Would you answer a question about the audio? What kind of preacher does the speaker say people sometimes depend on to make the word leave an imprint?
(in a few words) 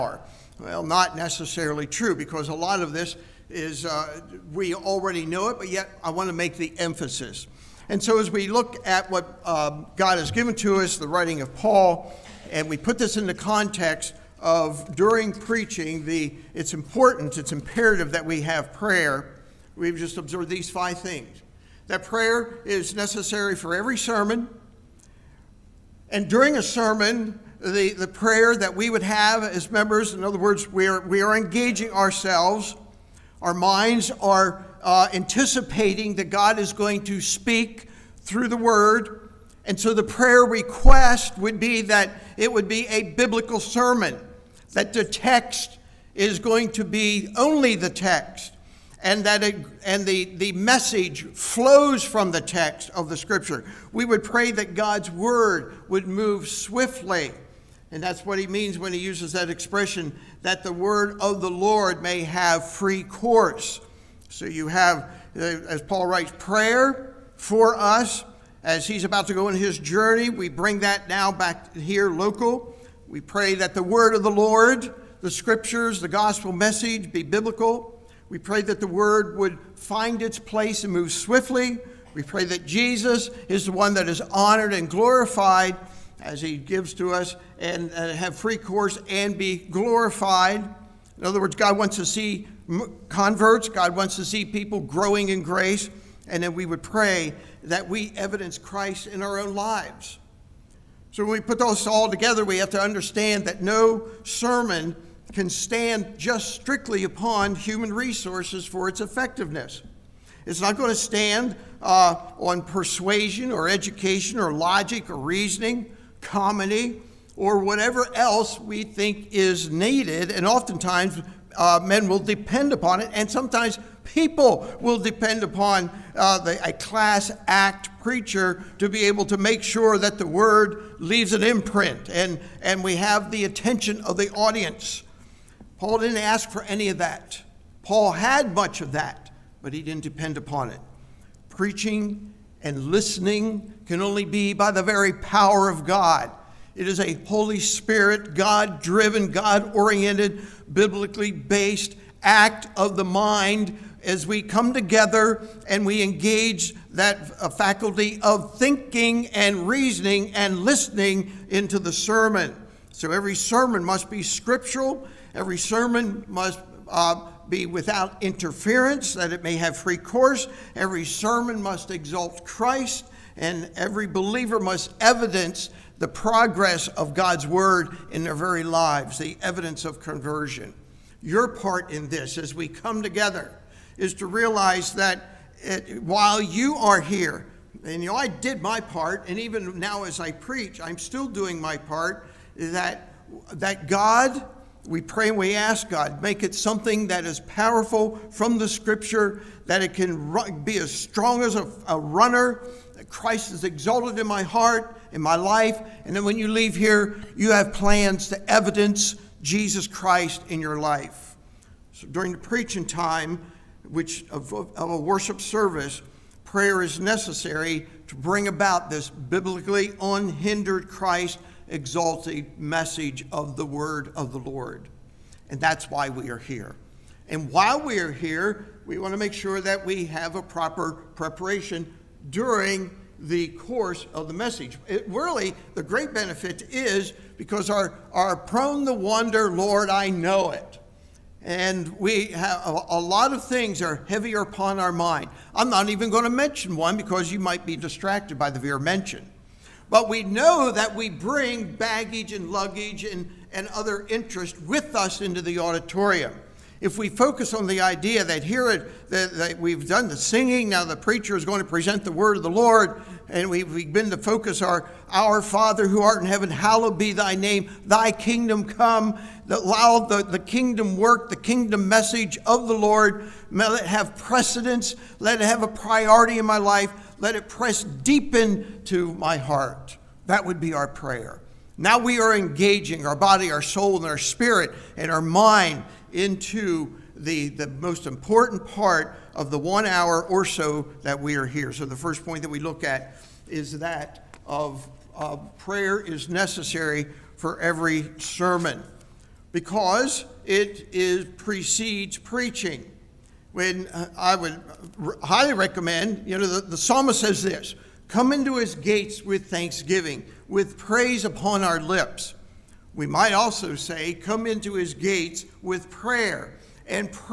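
a class act preacher.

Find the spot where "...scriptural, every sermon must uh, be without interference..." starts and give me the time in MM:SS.
02:44.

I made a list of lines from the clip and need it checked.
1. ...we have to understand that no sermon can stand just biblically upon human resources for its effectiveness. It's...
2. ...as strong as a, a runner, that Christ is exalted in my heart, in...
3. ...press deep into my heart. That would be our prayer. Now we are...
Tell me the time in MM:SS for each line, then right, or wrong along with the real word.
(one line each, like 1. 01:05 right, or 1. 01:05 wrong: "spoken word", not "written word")
1. 01:42 wrong: "strictly", not "biblically"
2. 03:20 right
3. 04:37 right.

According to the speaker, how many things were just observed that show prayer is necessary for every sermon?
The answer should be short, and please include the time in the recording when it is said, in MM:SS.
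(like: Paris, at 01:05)
5, at 00:20.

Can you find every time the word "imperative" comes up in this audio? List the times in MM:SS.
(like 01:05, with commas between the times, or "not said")
00:17.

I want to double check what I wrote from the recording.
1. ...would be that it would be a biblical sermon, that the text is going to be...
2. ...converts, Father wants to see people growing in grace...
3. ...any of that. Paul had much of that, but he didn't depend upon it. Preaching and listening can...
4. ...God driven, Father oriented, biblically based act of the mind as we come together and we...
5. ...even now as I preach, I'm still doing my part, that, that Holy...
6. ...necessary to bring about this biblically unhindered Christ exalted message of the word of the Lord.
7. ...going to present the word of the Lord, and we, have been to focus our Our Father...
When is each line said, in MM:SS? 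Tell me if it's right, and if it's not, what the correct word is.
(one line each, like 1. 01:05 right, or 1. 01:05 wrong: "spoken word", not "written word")
1. 00:41 right
2. 01:33 wrong: "God", not "Father"
3. 02:16 right
4. 02:28 wrong: "God", not "Father"
5. 03:09 wrong: "God", not "Holy"
6. 03:36 right
7. 04:21 right.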